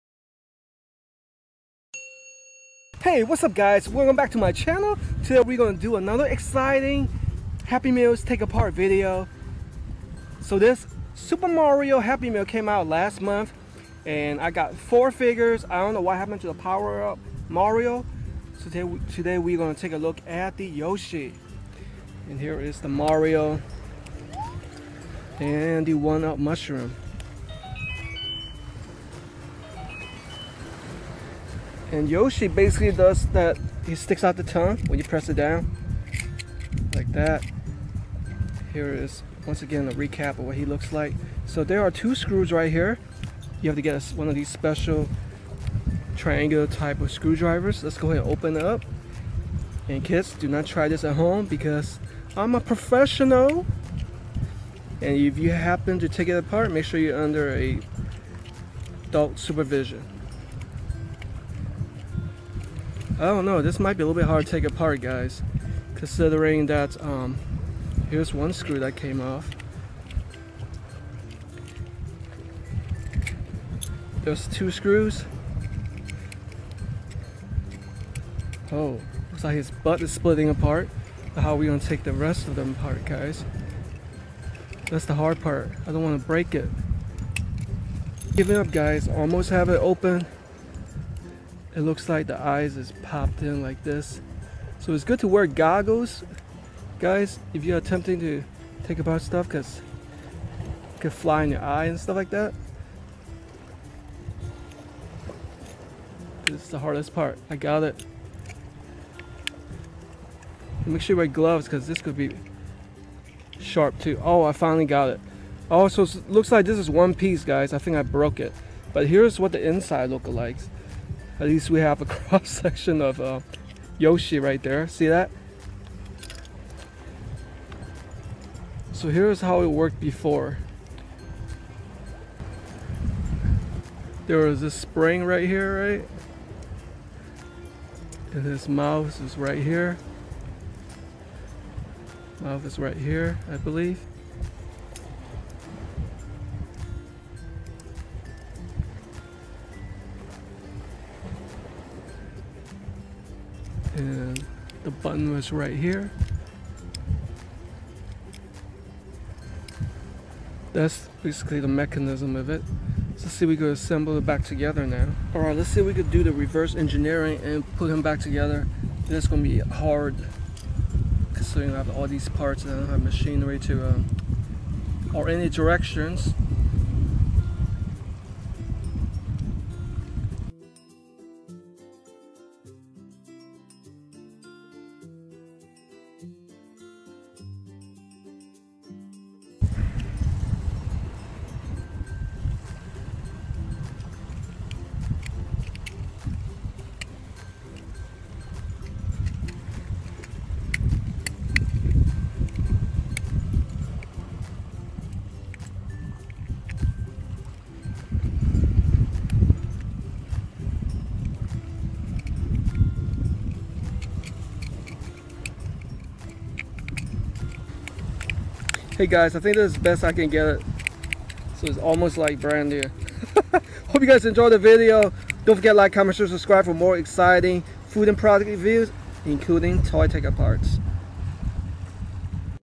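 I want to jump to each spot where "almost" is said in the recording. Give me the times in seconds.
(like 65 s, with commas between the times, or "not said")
89 s, 221 s.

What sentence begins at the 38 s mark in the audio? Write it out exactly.
Here is, once again, a recap of what he looks like.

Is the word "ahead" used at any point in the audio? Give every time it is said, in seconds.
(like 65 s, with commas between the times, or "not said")
48 s.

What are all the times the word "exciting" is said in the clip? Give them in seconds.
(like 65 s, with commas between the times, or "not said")
6 s, 226 s.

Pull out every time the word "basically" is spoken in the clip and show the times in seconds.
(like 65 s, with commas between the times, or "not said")
32 s, 161 s.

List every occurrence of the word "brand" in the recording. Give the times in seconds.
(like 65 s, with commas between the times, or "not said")
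222 s.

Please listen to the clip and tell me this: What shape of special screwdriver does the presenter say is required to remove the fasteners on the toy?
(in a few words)
Triangular.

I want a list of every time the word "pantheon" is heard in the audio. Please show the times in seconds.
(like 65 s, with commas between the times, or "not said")
not said.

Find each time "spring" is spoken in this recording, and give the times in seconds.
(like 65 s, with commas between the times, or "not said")
134 s.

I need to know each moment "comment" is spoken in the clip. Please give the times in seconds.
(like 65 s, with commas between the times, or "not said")
225 s.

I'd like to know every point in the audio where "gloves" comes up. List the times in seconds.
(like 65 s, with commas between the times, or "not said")
111 s.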